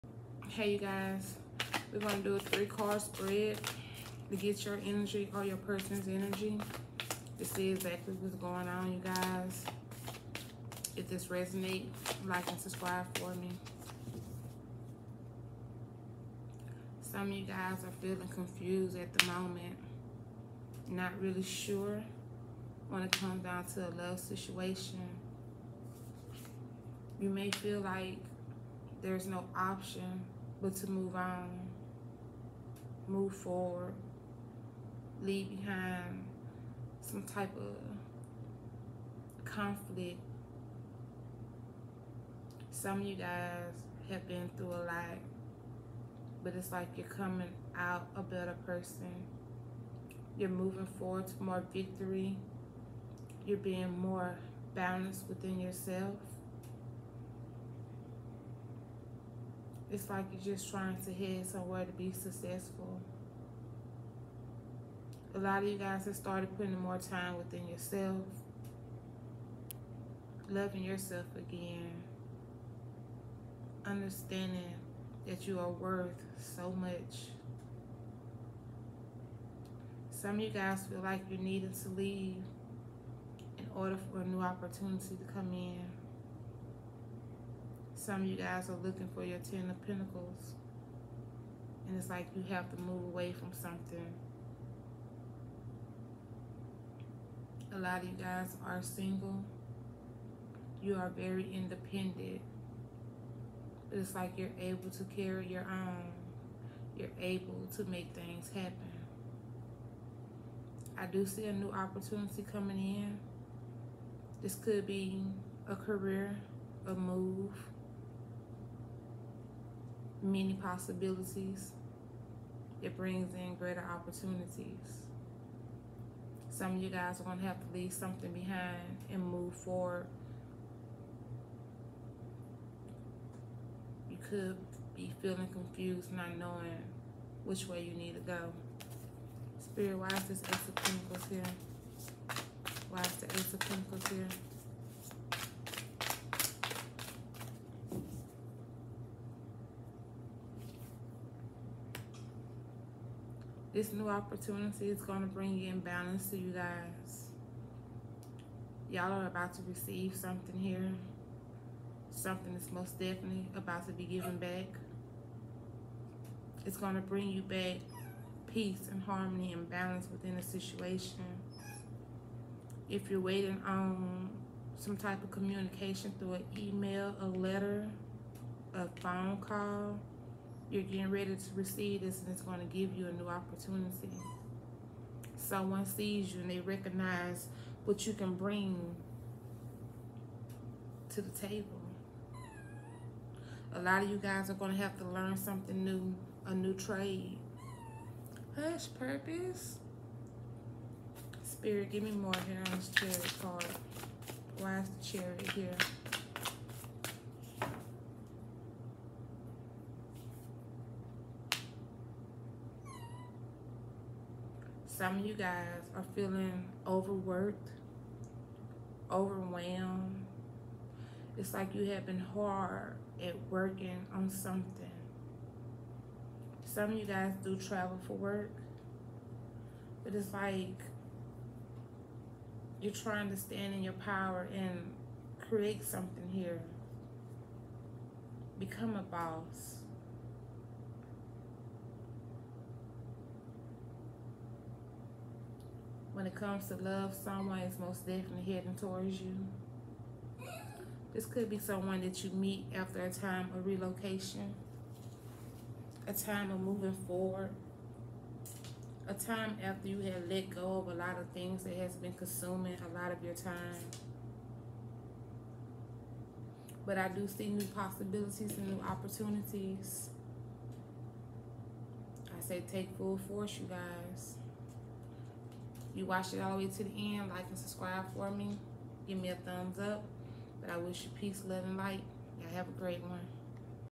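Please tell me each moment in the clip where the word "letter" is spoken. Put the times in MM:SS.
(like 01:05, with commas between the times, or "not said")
02:57.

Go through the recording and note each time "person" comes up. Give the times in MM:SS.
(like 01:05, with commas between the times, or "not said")
00:05, 00:48.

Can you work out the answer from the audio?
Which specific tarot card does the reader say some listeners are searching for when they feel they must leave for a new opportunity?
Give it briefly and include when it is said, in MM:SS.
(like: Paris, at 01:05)
Ten of Pentacles, at 01:29.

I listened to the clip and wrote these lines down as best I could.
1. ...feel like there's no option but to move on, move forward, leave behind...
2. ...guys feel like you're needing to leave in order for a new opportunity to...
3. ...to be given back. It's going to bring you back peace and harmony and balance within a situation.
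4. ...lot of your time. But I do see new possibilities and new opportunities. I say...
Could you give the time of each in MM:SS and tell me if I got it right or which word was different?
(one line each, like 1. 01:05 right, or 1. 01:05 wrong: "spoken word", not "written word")
1. 00:27 right
2. 01:20 right
3. 02:43 right
4. 04:22 right.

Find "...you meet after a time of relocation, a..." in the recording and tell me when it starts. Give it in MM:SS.
04:12.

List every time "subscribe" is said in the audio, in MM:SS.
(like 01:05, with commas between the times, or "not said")
00:12, 04:37.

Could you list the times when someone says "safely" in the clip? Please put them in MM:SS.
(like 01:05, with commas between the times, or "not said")
not said.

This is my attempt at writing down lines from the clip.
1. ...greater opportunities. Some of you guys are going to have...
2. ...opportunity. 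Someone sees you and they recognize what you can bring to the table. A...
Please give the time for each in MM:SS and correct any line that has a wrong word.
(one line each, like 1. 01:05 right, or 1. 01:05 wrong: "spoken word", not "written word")
1. 02:03 right
2. 03:03 right.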